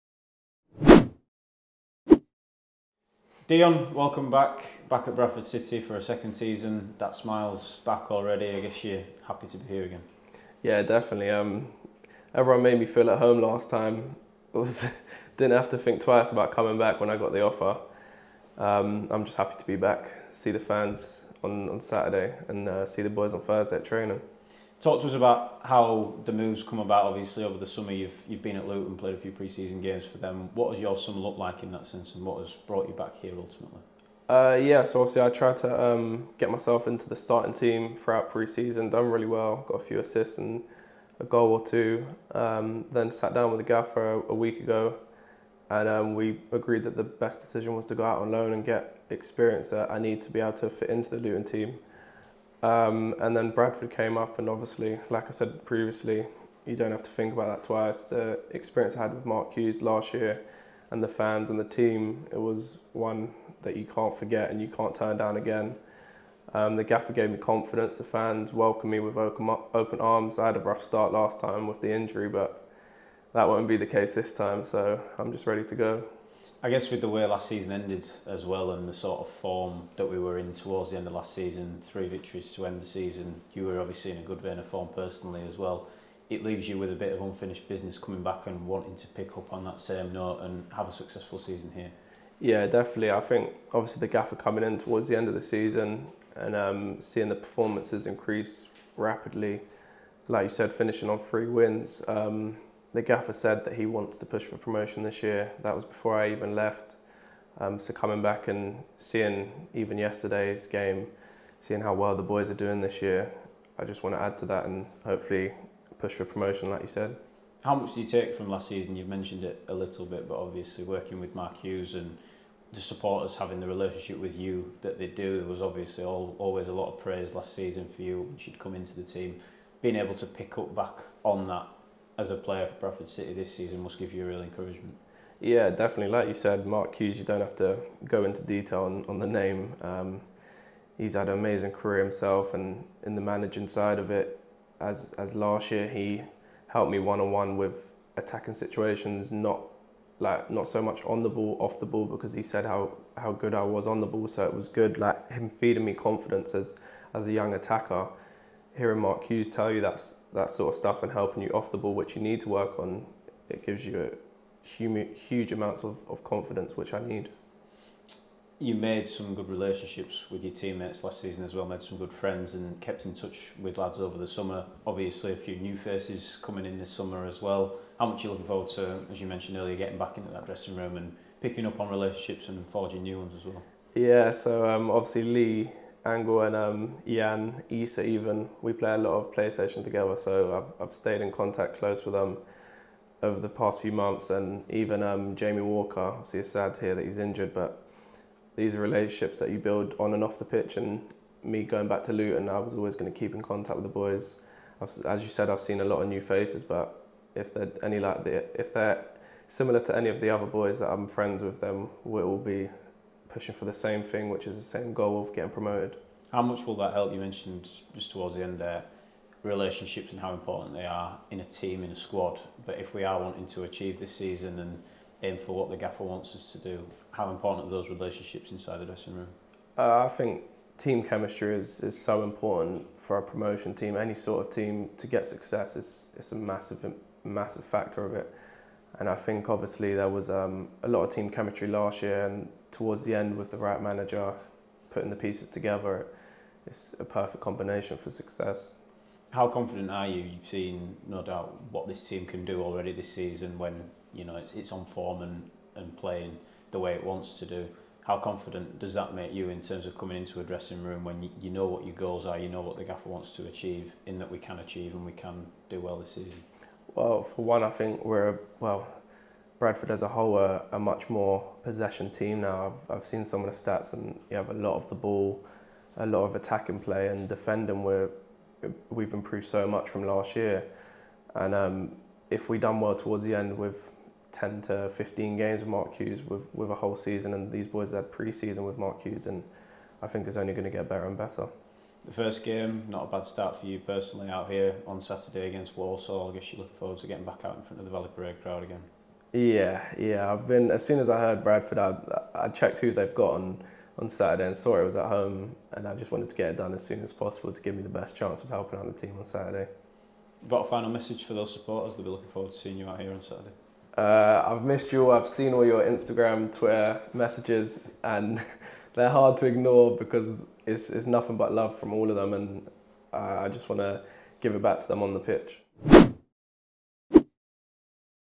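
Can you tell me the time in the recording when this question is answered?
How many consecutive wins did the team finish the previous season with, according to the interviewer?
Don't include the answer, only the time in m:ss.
1:21.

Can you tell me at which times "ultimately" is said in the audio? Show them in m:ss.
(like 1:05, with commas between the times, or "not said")
0:33.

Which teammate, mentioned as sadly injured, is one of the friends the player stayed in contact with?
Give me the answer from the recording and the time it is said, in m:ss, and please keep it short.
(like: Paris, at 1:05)
Jamie Walker, at 3:15.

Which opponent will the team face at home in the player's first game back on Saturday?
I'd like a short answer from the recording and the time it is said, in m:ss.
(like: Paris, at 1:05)
Walsall, at 4:55.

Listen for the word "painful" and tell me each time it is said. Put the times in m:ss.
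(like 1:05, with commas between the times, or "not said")
not said.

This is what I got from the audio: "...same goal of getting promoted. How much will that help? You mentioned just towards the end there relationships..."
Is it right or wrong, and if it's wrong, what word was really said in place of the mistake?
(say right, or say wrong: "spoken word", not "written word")
right.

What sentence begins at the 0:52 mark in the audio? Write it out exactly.
Um, and then Bradford came up, and obviously, like I said previously, you don't have to think about that twice.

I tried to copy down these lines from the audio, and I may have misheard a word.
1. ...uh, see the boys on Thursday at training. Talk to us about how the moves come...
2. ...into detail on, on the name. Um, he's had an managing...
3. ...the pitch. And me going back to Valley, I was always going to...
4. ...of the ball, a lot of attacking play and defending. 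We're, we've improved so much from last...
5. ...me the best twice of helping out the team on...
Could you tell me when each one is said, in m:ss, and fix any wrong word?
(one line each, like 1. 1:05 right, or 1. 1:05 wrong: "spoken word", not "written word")
1. 0:22 right
2. 2:18 wrong: "amazing", not "managing"
3. 3:20 wrong: "Luton", not "Valley"
4. 4:34 right
5. 5:07 wrong: "chance", not "twice".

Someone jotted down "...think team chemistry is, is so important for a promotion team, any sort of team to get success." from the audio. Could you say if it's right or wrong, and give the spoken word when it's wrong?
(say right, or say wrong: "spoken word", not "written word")
right.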